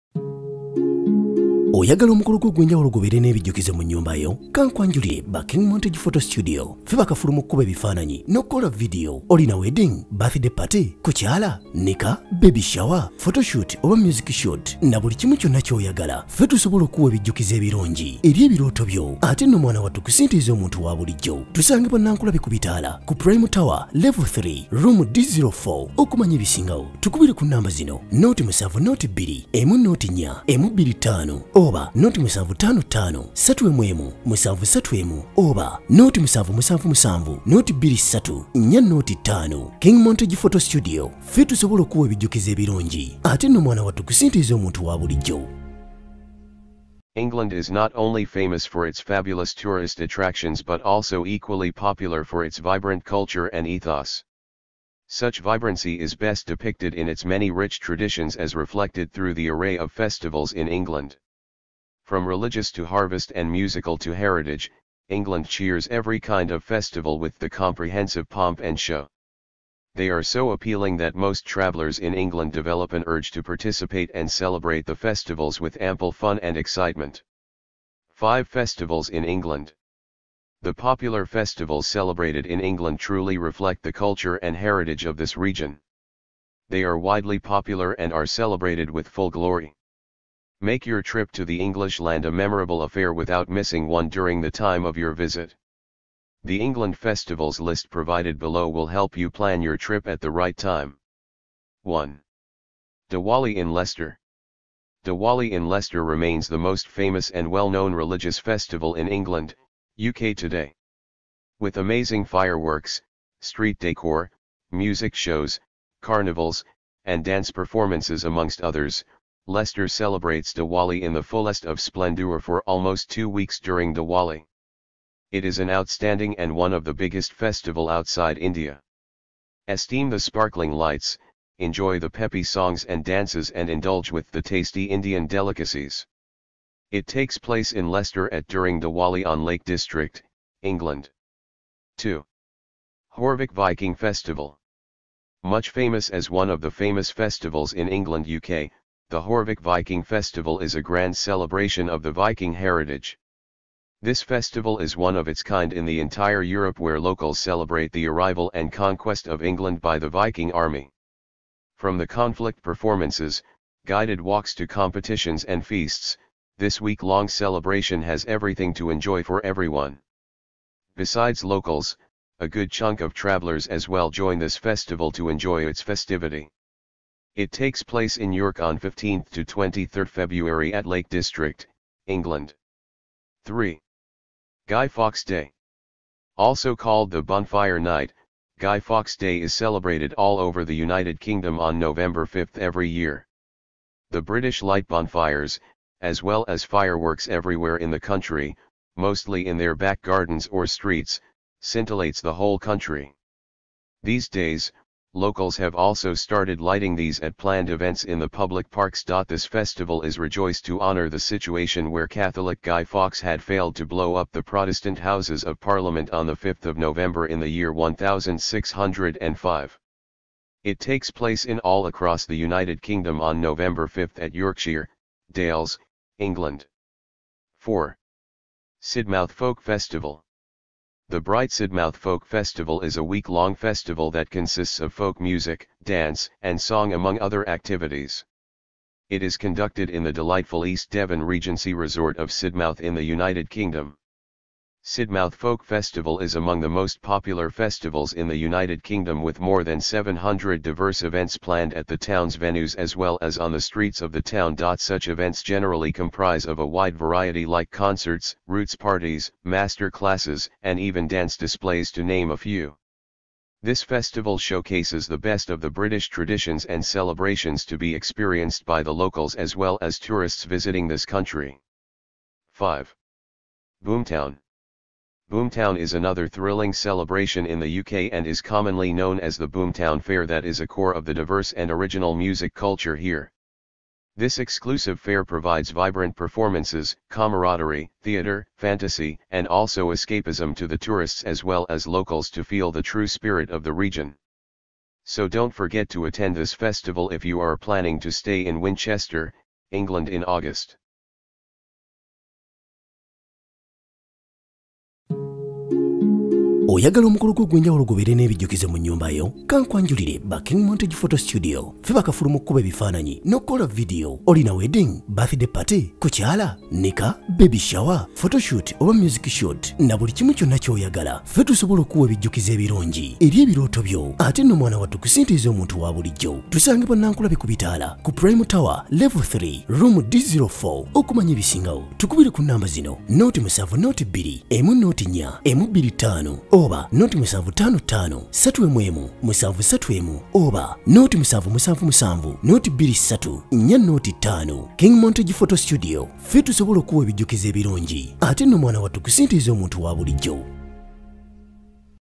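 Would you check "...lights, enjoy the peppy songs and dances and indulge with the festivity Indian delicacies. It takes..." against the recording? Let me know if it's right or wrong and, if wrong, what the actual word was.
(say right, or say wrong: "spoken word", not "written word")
wrong: "tasty", not "festivity".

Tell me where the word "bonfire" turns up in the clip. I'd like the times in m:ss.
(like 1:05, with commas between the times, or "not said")
3:07, 3:14.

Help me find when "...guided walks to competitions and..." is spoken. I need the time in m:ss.
2:43.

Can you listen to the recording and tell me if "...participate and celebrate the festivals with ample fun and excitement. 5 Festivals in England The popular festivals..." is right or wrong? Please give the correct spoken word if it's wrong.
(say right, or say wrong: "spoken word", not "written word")
right.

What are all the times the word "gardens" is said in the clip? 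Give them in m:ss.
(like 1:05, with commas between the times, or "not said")
3:20.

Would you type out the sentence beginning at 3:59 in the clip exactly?
It is conducted in the delightful East Devon Regency Resort of Sidmouth in the United Kingdom.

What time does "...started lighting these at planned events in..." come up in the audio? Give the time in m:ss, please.
3:26.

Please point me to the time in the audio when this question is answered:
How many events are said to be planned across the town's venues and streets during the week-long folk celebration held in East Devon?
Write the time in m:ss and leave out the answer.
4:09.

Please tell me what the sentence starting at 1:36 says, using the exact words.
The England festivals list provided below will help you plan your trip at the right time.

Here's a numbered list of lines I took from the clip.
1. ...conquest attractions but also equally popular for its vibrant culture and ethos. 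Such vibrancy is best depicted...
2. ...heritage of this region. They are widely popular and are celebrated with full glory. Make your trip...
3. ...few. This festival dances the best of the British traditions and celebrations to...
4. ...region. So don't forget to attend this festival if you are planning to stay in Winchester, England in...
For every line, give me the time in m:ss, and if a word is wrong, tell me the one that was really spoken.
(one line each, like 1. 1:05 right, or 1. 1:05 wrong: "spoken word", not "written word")
1. 0:49 wrong: "tourist", not "conquest"
2. 1:24 right
3. 4:22 wrong: "showcases", not "dances"
4. 4:53 right.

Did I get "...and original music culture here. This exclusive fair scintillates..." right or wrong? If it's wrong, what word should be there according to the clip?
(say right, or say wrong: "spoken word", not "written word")
wrong: "provides", not "scintillates".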